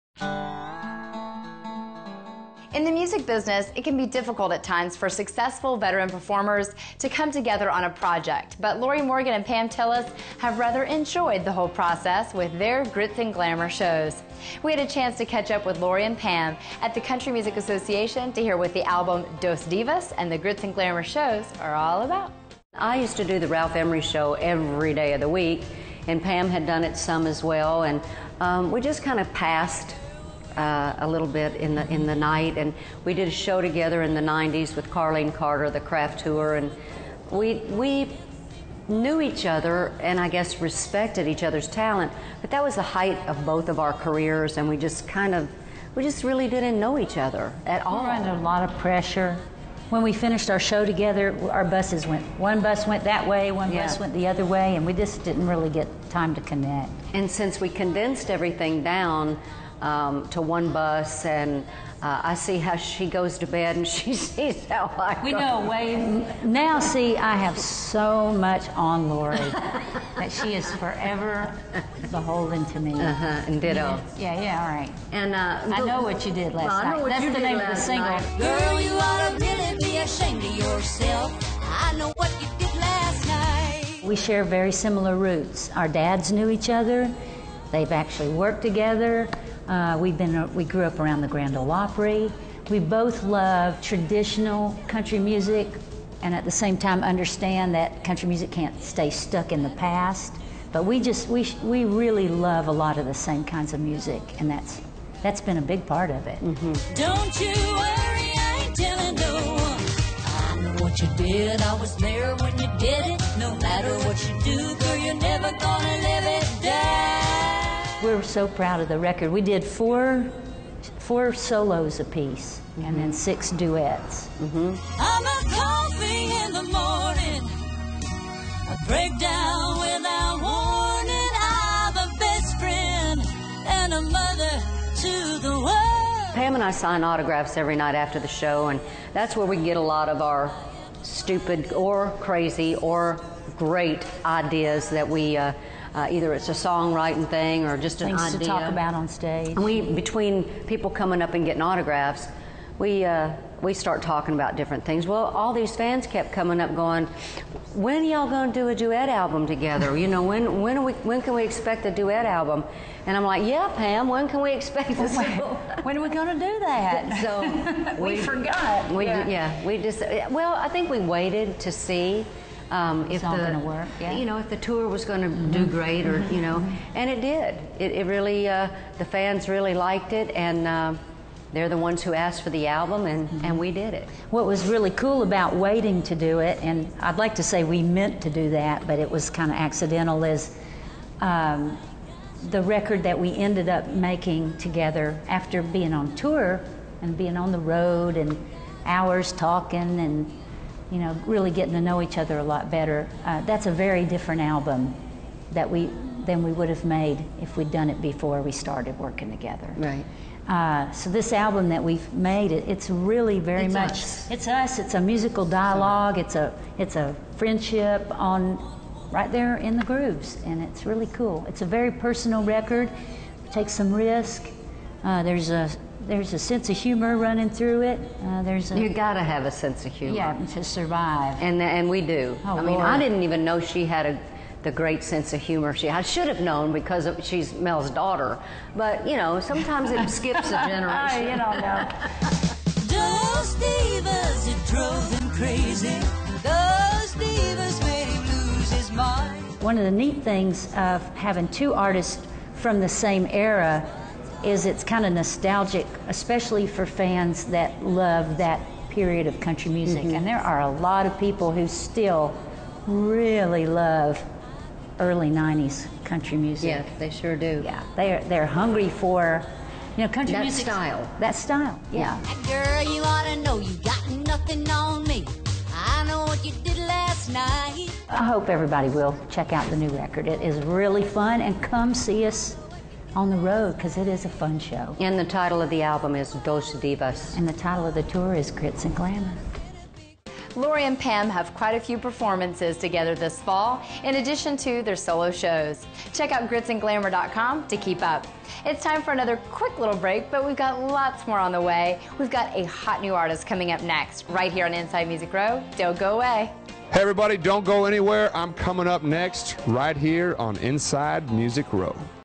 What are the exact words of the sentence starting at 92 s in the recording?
We both love traditional country music and at the same time understand that country music can't stay stuck in the past.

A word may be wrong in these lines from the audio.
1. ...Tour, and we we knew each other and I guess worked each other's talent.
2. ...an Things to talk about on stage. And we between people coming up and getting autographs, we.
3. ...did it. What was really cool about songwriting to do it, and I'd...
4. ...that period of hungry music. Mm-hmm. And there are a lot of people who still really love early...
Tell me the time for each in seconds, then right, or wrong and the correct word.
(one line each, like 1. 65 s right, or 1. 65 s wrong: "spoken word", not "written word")
1. 36 s wrong: "respected", not "worked"
2. 148 s right
3. 183 s wrong: "waiting", not "songwriting"
4. 258 s wrong: "country", not "hungry".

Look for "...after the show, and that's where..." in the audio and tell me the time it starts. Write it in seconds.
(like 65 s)
137 s.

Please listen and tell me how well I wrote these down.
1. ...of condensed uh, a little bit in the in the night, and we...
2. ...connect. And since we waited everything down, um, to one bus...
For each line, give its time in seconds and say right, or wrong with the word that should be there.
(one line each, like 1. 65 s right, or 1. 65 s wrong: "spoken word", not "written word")
1. 29 s wrong: "passed", not "condensed"
2. 56 s wrong: "condensed", not "waited".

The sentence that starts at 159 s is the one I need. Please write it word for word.
You know, when when we when can we expect a duet album?" And I'm like, "Yeah, Pam, when can we expect this?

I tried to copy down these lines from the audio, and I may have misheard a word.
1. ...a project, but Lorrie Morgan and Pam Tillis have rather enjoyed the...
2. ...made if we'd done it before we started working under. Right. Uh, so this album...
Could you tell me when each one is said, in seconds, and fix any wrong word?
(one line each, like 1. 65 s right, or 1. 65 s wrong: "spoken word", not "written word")
1. 7 s right
2. 206 s wrong: "together", not "under".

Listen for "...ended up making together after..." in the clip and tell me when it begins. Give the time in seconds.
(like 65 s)
193 s.